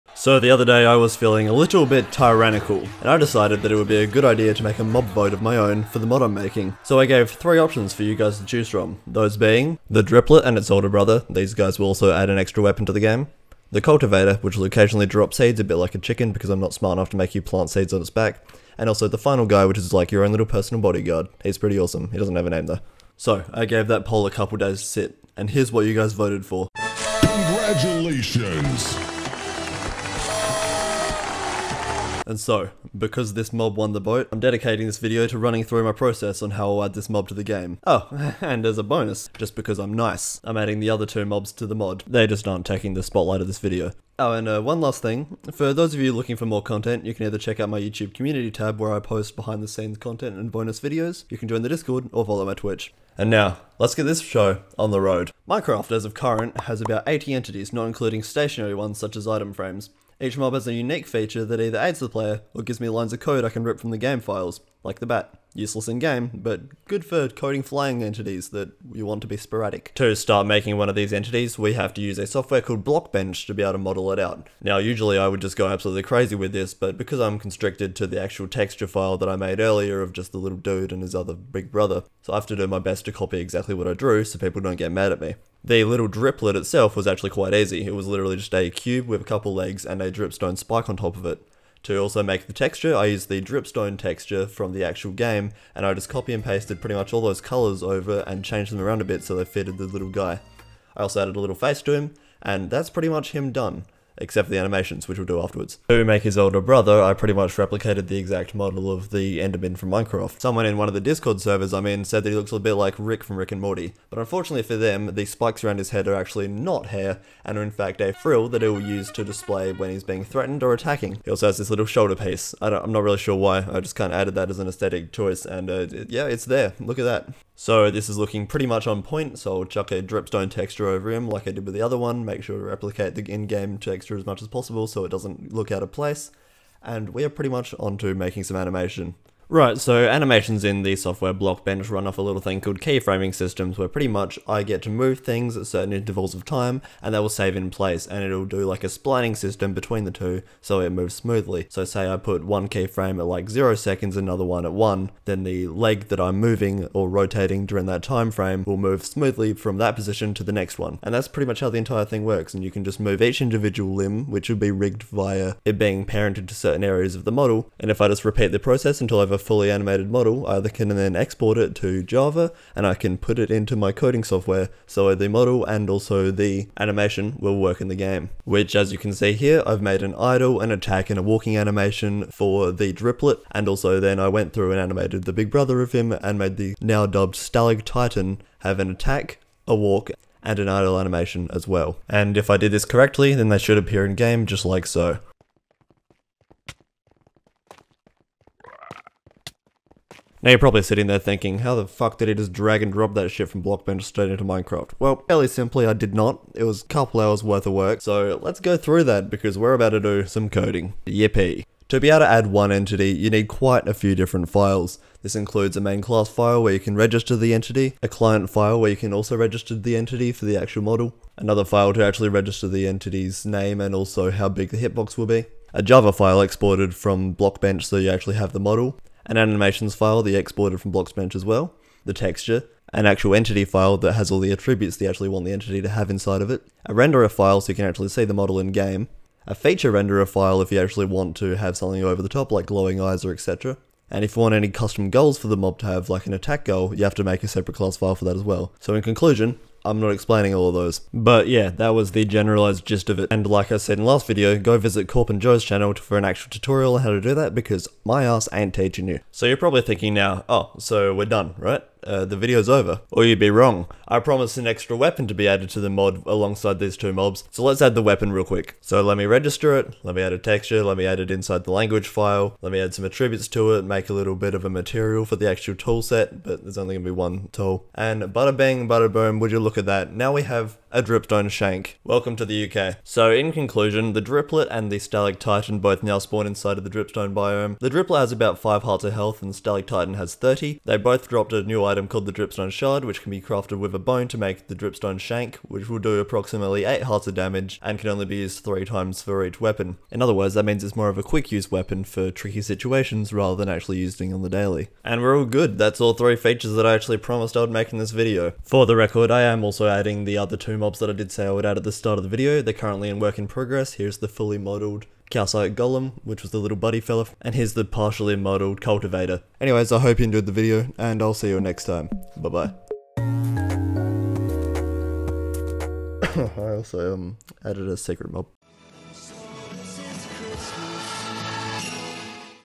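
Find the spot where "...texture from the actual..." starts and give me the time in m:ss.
1:33.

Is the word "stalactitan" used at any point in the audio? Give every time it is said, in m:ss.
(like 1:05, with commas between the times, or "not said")
3:07, 4:44, 4:49.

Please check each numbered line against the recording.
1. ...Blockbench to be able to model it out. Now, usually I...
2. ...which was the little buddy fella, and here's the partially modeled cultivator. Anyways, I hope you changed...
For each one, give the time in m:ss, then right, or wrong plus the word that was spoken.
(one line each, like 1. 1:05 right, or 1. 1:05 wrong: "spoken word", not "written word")
1. 1:12 right
2. 5:16 wrong: "enjoyed", not "changed".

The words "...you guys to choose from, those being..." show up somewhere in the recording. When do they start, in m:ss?
0:08.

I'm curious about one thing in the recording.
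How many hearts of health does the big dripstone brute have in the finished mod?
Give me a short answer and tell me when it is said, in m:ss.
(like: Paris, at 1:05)
30, at 4:50.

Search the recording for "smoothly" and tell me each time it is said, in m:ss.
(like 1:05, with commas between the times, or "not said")
2:31, 2:39.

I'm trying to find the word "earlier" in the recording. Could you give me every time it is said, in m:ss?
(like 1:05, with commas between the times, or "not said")
1:19.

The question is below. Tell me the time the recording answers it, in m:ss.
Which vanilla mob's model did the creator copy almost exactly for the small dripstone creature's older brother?
1:49.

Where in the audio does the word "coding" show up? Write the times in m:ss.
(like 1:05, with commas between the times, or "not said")
1:07, 2:53, 3:30.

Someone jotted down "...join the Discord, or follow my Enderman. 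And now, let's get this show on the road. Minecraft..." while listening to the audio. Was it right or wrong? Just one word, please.
wrong.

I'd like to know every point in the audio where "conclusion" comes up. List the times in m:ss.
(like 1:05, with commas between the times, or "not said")
4:09, 4:43.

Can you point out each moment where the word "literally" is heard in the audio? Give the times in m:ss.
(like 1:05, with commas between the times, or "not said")
1:28.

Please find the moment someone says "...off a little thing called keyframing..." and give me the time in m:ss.
2:22.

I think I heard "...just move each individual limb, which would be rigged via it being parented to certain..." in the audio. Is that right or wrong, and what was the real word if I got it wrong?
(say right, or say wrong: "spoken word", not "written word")
right.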